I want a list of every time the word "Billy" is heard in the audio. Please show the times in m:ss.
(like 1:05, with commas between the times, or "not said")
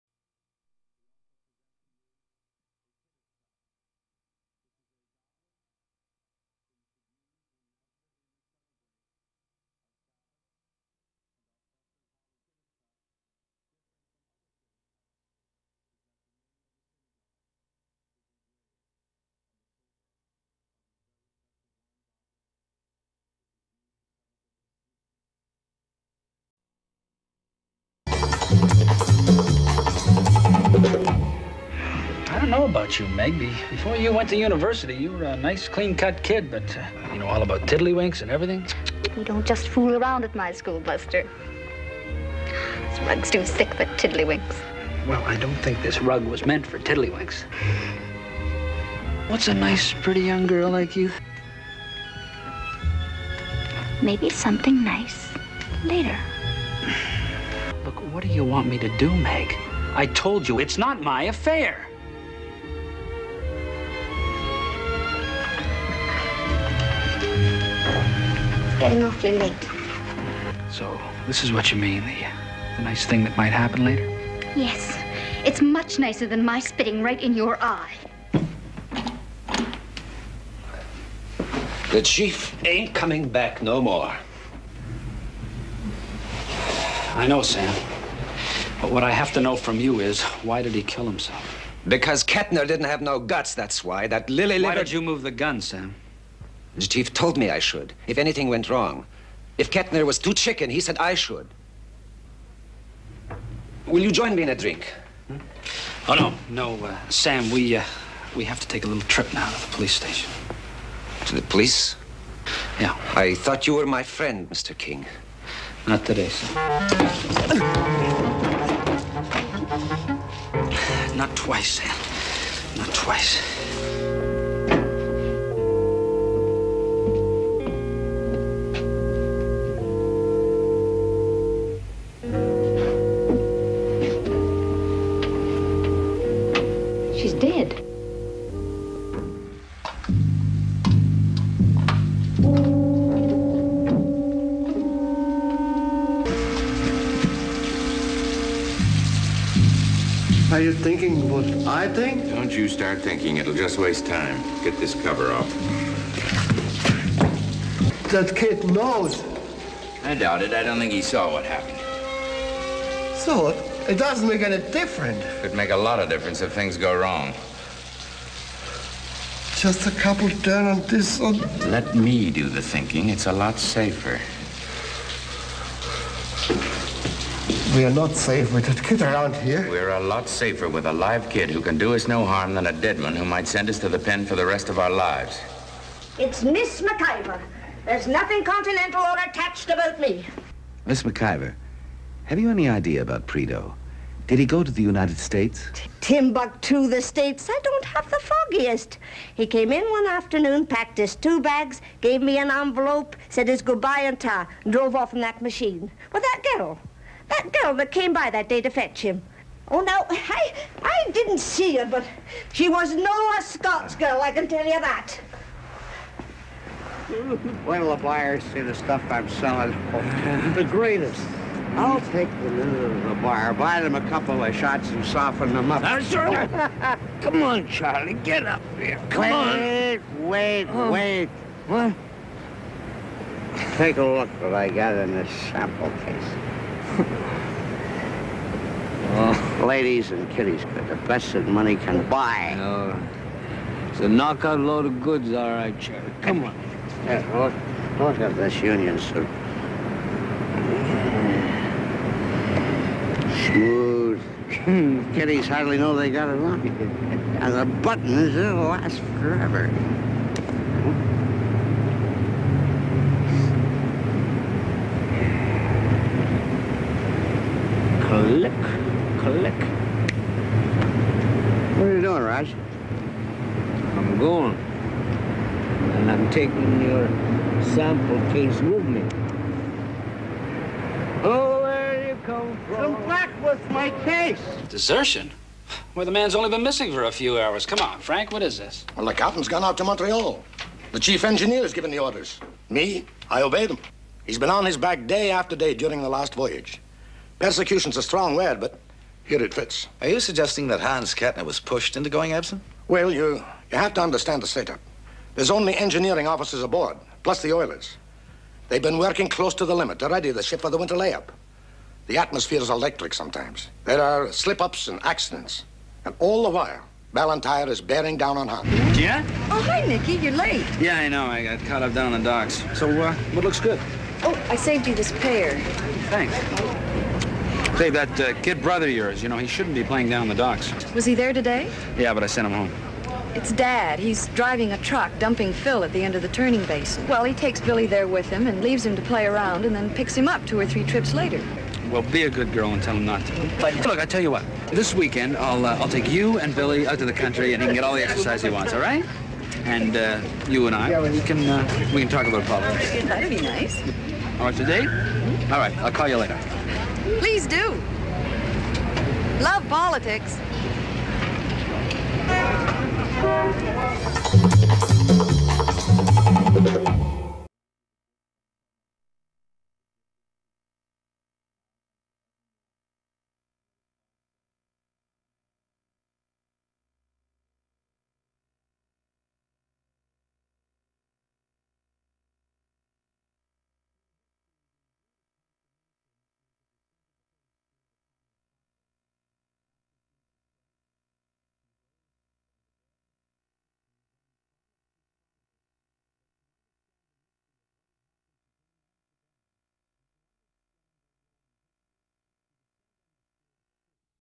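5:37, 5:46.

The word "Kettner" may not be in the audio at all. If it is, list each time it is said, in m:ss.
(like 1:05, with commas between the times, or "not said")
1:32, 1:39, 5:01.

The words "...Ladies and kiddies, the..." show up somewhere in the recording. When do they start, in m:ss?
3:59.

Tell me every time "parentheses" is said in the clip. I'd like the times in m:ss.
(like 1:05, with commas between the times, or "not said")
not said.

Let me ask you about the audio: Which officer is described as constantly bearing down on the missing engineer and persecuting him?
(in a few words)
Ballantyre.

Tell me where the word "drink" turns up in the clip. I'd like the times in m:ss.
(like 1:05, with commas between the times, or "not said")
1:44.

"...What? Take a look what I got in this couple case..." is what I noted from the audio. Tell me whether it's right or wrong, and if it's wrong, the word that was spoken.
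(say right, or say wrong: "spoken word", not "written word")
wrong: "sample", not "couple".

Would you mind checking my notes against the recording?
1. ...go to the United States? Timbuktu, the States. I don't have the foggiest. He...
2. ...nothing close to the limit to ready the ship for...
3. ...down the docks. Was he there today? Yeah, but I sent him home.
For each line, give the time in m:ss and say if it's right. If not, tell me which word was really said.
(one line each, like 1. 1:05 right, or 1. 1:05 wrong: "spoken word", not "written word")
1. 3:14 right
2. 5:08 wrong: "working", not "nothing"
3. 5:30 right.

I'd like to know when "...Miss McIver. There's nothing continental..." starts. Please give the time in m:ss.
3:06.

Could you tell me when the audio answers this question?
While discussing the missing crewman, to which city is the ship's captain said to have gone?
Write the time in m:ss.
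4:49.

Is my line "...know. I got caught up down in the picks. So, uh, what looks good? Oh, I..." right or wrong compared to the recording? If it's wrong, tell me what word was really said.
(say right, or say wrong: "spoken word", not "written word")
wrong: "docks", not "picks".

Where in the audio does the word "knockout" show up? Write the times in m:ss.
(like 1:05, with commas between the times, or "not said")
4:04.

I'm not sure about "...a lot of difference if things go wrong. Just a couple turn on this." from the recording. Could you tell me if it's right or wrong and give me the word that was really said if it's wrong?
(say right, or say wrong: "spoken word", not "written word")
right.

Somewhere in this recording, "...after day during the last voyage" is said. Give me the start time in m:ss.
4:55.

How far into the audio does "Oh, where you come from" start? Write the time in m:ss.
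4:41.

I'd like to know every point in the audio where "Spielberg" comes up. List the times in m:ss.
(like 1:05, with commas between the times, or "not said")
not said.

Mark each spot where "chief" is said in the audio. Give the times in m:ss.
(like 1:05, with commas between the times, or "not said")
1:22, 1:36, 4:50.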